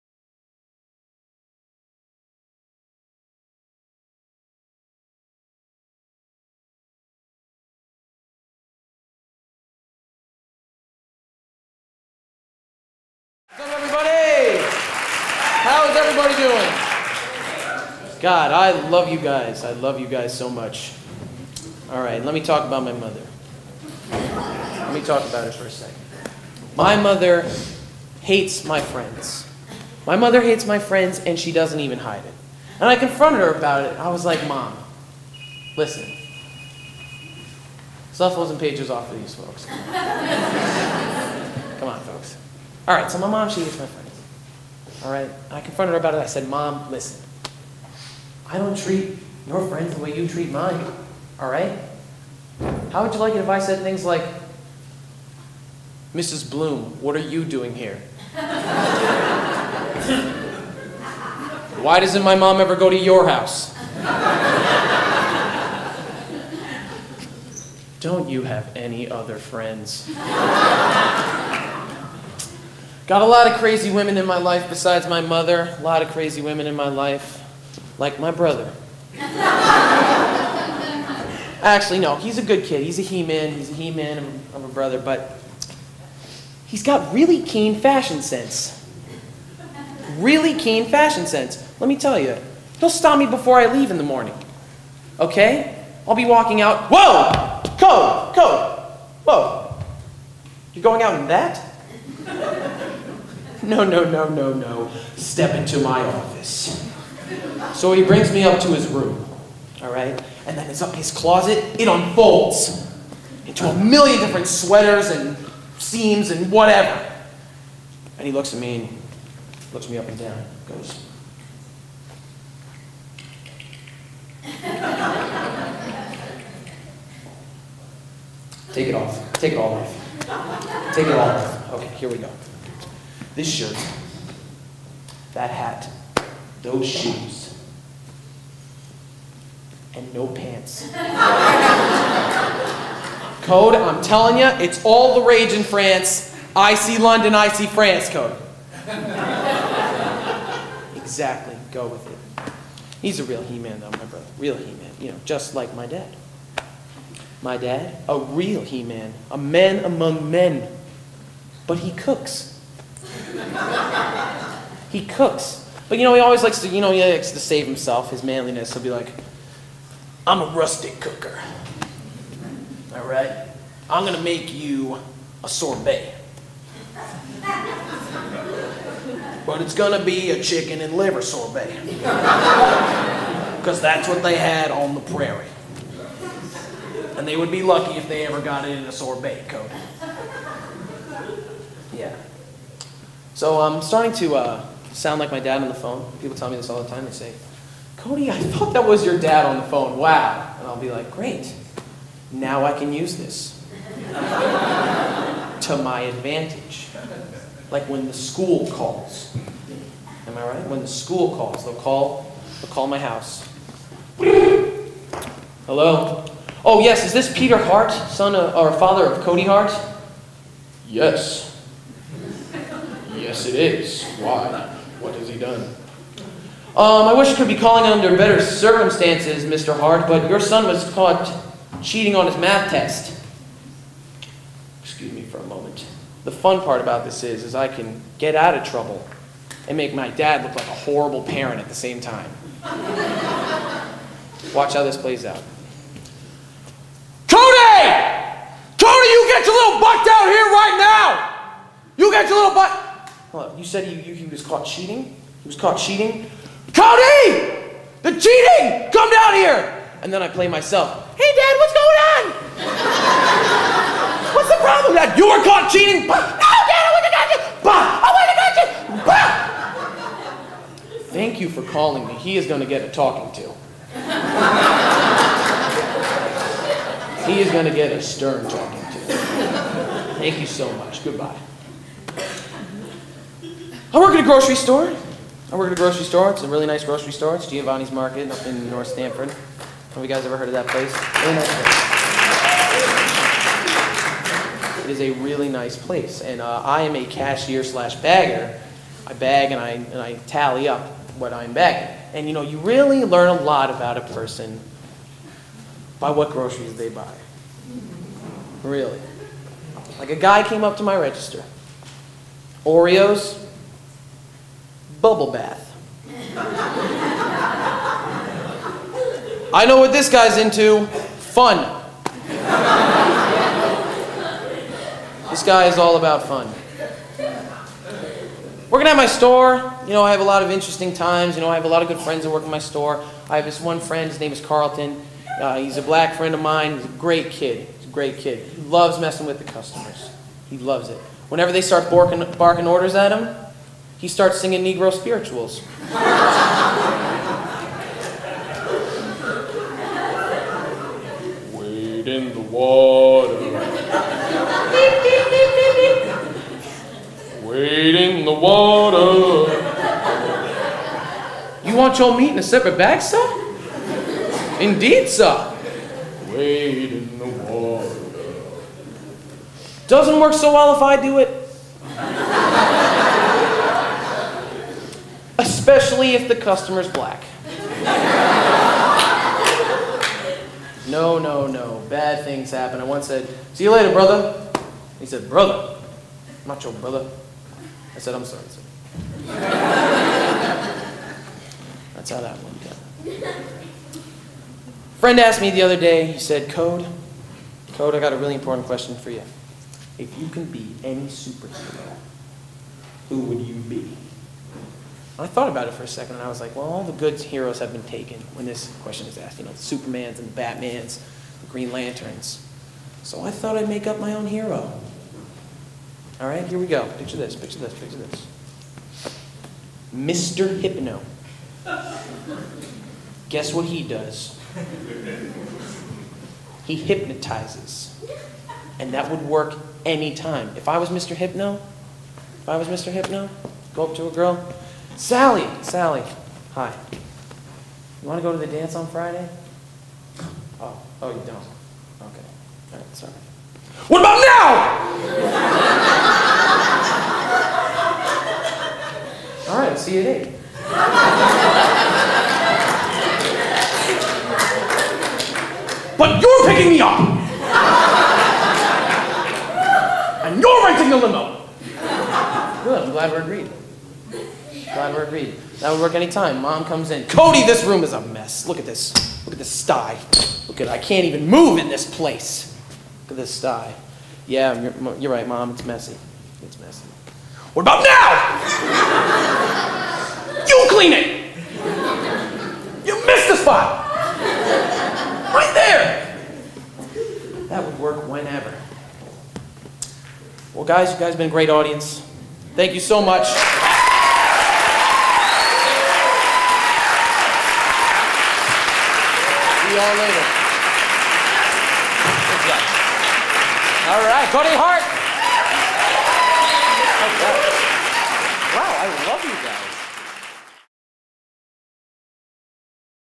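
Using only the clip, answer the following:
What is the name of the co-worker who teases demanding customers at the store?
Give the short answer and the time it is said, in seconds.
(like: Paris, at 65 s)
Carlton, at 334 s.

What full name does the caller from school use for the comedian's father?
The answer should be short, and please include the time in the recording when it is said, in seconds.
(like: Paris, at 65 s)
Peter Hart, at 217 s.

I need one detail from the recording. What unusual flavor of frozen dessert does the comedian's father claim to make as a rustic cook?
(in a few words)
chicken and liver.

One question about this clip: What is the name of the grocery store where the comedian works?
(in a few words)
Giovanni's Market.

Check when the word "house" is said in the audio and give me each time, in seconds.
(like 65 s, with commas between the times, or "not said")
63 s, 212 s.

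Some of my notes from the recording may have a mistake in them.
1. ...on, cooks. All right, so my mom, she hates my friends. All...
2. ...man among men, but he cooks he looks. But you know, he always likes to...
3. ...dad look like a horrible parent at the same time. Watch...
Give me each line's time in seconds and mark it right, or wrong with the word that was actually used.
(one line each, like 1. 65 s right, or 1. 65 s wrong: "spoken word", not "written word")
1. 41 s wrong: "folks", not "cooks"
2. 159 s wrong: "cooks", not "looks"
3. 240 s right.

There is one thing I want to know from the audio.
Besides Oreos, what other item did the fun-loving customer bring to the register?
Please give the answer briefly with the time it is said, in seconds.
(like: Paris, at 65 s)
bubble bath, at 315 s.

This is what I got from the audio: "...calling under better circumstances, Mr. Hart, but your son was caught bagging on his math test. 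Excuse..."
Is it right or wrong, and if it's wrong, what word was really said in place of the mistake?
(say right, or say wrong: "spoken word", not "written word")
wrong: "cheating", not "bagging".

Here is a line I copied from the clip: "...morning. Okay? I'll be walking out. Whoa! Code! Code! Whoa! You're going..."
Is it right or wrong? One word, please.
right.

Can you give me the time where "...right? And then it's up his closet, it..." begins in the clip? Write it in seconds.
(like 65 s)
109 s.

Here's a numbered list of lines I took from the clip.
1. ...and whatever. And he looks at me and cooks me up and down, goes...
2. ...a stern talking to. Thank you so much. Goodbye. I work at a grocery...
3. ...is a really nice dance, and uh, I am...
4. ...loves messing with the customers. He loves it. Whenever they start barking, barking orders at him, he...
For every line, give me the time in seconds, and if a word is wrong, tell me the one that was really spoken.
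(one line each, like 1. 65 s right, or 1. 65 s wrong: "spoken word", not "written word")
1. 116 s wrong: "looks", not "cooks"
2. 277 s right
3. 294 s wrong: "place", not "dance"
4. 338 s right.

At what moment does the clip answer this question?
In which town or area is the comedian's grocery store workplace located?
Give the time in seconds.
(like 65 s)
288 s.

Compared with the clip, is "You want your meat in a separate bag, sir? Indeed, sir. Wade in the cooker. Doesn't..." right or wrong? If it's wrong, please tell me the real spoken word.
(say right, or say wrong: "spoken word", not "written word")
wrong: "water", not "cooker".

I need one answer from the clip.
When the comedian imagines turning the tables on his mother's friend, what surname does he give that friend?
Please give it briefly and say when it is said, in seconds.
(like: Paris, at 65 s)
Mrs. Bloom, at 56 s.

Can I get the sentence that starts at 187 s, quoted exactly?
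And they would be lucky if they ever got it in a sorbet coating.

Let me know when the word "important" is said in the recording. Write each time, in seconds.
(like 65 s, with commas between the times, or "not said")
398 s.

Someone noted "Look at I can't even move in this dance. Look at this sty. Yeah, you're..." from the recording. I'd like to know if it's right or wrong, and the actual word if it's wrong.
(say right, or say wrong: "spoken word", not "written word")
wrong: "place", not "dance".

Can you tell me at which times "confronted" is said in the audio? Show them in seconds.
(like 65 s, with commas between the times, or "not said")
32 s, 45 s.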